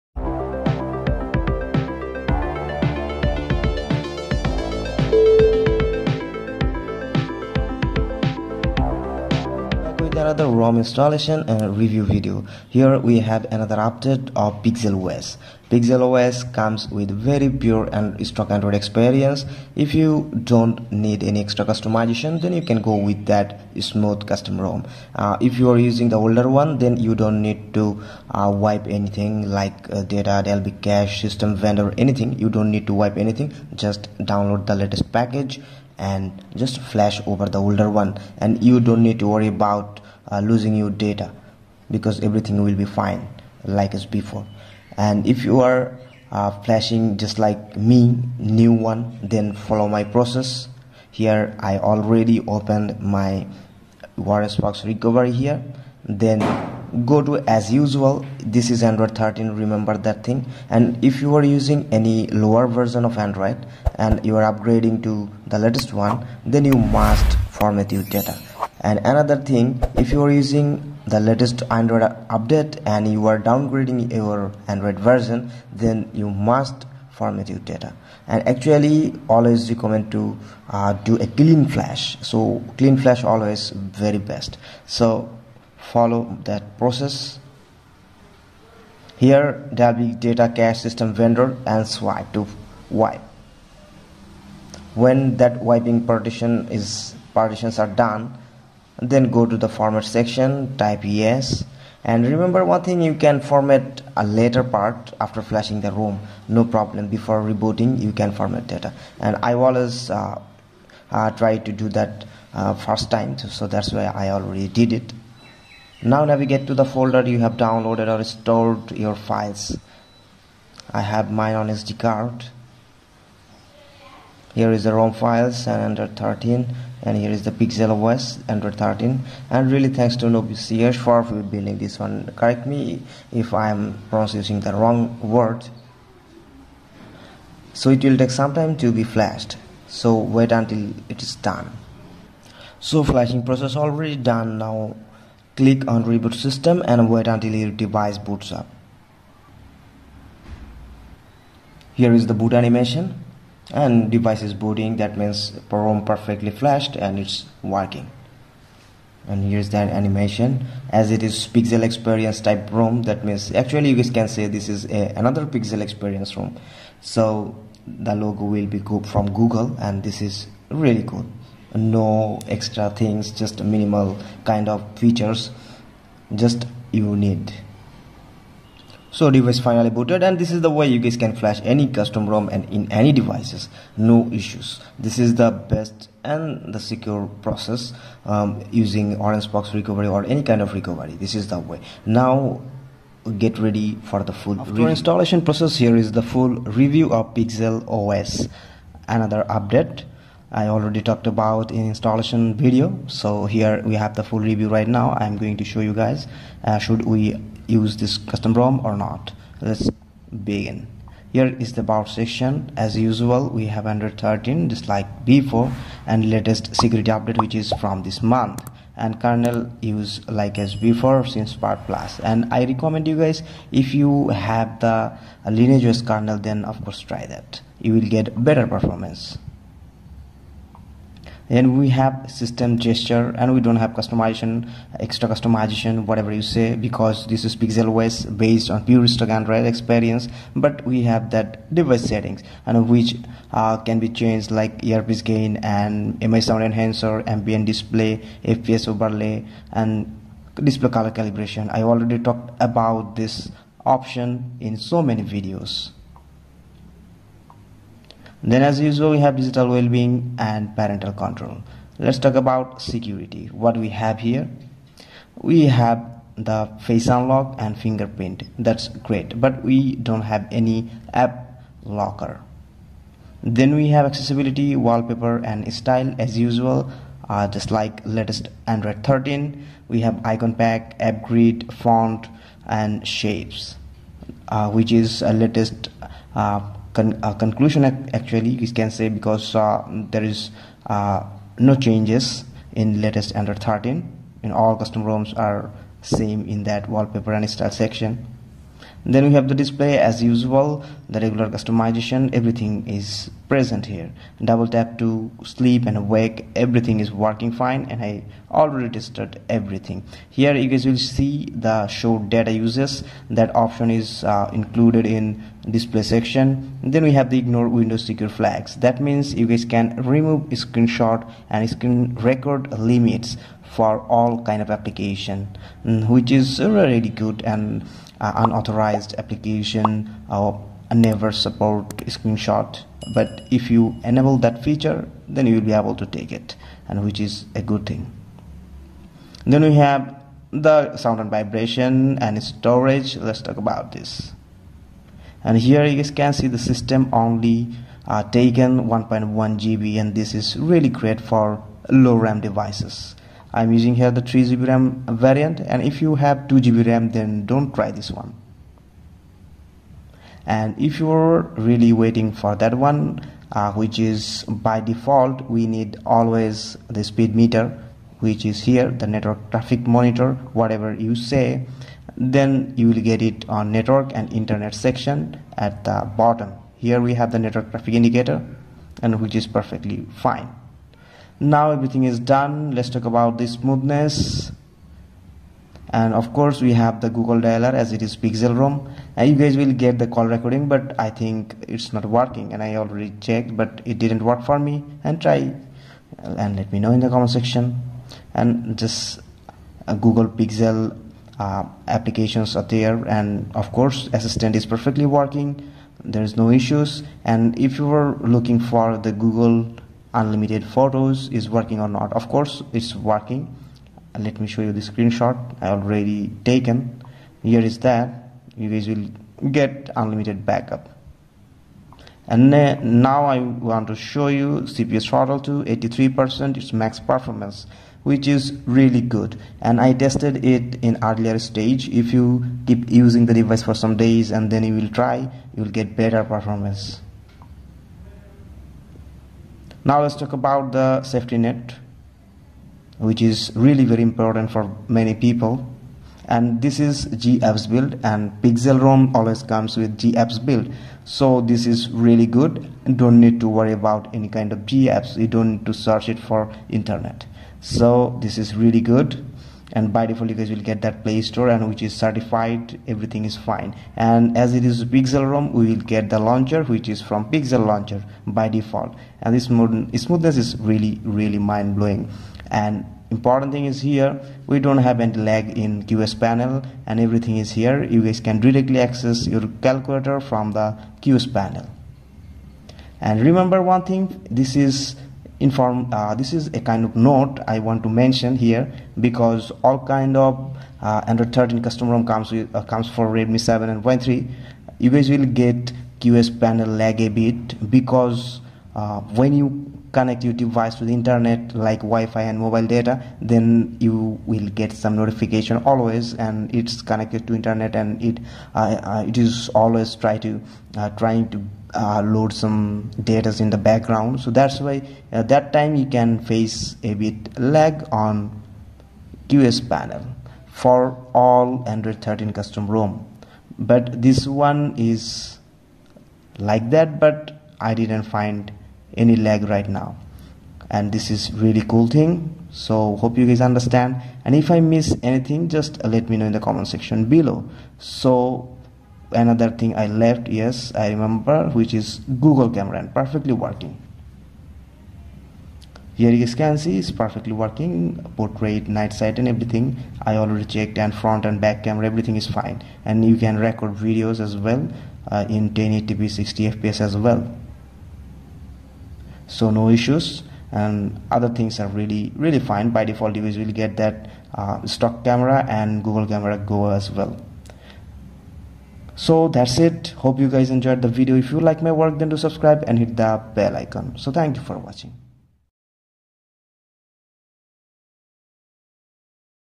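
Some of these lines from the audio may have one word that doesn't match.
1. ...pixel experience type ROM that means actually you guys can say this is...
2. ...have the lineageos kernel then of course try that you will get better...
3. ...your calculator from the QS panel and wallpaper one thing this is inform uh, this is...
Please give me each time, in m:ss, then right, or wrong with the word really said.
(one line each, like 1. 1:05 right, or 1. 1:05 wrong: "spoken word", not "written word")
1. 2:41 right
2. 3:44 right
3. 7:59 wrong: "remember", not "wallpaper".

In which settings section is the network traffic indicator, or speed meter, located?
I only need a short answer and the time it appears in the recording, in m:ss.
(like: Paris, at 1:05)
Network and internet, at 6:13.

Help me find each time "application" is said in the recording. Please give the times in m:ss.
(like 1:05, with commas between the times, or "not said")
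5:24, 5:29, 6:41.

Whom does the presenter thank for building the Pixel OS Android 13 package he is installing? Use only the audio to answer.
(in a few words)
Noviceyash.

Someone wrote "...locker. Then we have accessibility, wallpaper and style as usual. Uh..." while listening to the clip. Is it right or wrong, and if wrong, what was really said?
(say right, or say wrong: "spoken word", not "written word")
right.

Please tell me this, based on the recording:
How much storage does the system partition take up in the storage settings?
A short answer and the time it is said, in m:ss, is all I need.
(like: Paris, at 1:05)
1.1 GB, at 5:48.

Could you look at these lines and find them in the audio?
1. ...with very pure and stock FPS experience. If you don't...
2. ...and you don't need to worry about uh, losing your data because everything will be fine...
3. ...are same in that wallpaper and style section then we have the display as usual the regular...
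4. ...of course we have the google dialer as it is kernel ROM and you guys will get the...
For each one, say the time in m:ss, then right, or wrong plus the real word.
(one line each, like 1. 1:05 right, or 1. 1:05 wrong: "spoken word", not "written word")
1. 0:16 wrong: "Android", not "FPS"
2. 0:38 right
3. 4:55 right
4. 6:26 wrong: "pixel", not "kernel".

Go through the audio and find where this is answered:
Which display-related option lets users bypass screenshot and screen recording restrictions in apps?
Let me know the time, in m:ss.
5:17.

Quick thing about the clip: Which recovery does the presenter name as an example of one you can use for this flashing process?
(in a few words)
OrangeFox recovery.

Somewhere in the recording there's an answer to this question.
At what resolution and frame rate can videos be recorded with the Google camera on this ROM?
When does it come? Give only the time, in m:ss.
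9:15.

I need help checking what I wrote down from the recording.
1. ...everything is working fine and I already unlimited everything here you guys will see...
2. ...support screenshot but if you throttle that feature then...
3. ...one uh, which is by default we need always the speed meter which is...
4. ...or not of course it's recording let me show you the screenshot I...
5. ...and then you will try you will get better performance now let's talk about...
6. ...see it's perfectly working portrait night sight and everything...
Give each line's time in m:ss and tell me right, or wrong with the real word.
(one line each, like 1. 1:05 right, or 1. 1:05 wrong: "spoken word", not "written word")
1. 5:06 wrong: "tested", not "unlimited"
2. 5:31 wrong: "enable", not "throttle"
3. 6:02 right
4. 6:51 wrong: "working", not "recording"
5. 7:14 right
6. 9:06 right.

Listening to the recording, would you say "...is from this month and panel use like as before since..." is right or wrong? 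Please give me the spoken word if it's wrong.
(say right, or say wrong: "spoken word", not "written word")
wrong: "kernel", not "panel".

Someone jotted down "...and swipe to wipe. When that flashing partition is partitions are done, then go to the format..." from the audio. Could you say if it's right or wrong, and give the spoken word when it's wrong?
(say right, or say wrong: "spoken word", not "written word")
wrong: "wiping", not "flashing".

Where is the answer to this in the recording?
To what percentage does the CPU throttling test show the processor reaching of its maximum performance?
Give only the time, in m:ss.
7:05.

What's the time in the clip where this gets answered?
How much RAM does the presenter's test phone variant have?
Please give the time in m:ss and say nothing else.
5:54.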